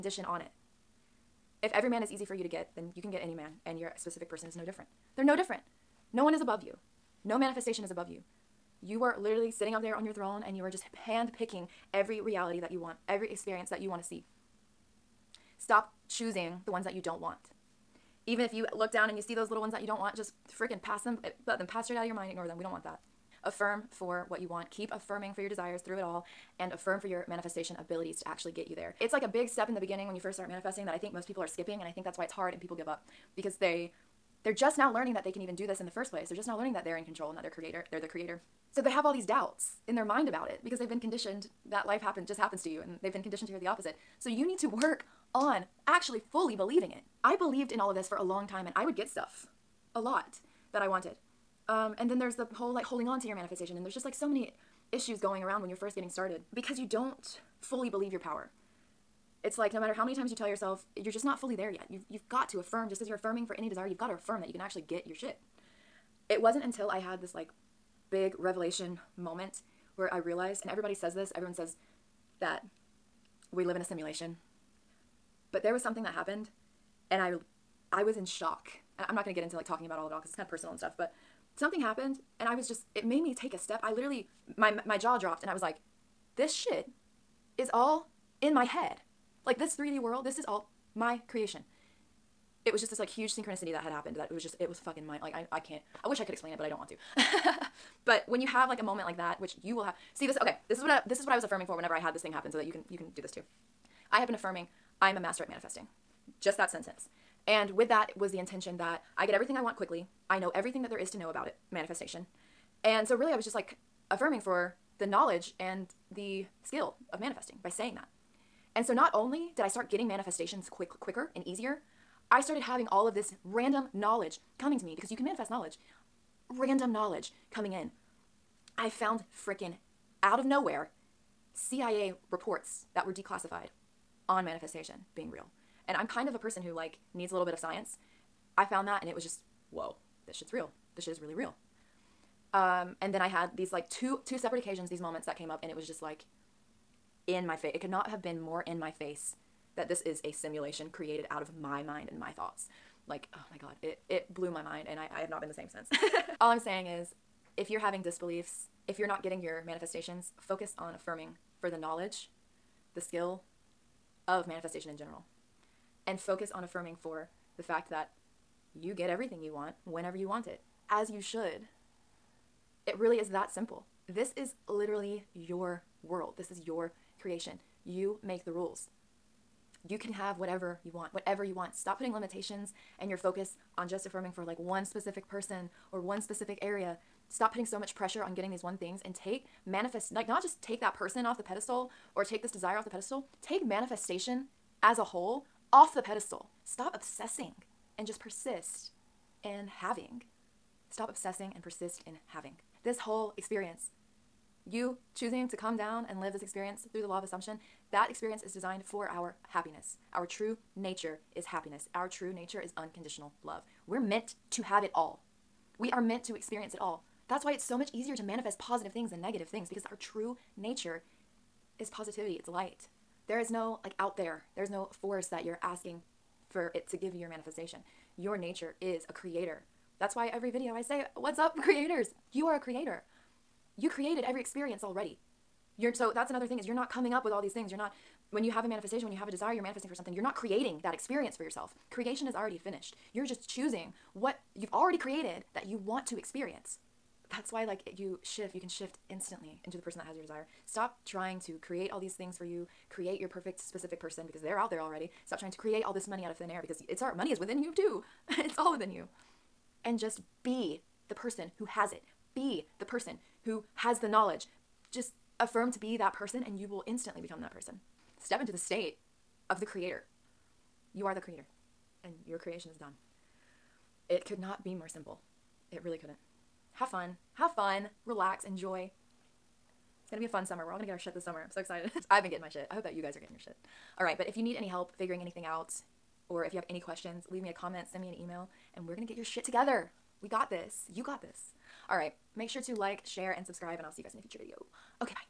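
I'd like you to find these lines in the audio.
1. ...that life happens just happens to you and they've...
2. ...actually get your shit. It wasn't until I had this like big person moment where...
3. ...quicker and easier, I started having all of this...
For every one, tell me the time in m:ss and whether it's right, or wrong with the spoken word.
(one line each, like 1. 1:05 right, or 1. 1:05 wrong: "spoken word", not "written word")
1. 0:41 right
2. 1:04 wrong: "revelation", not "person"
3. 2:01 right.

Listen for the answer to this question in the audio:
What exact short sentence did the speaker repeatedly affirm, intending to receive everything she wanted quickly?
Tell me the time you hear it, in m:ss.
1:45.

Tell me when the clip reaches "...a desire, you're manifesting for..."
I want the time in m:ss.
3:59.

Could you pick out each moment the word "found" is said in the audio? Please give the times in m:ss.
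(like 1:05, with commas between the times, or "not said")
2:08, 2:18.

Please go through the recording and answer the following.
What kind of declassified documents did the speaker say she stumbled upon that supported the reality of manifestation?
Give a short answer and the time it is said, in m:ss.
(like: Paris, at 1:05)
CIA reports, at 2:11.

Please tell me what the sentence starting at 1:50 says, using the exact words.
I know everything that there is to know about it, manifestation.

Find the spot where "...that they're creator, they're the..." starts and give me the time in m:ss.
0:37.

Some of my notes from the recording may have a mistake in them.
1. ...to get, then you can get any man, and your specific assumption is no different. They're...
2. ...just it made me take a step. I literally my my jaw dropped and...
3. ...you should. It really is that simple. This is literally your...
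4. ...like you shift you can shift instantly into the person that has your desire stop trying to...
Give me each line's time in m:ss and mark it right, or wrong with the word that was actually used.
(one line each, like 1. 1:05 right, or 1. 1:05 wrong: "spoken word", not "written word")
1. 0:02 wrong: "person", not "assumption"
2. 1:22 right
3. 2:51 right
4. 4:07 right.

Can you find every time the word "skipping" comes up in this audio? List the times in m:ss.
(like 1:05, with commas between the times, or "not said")
0:31.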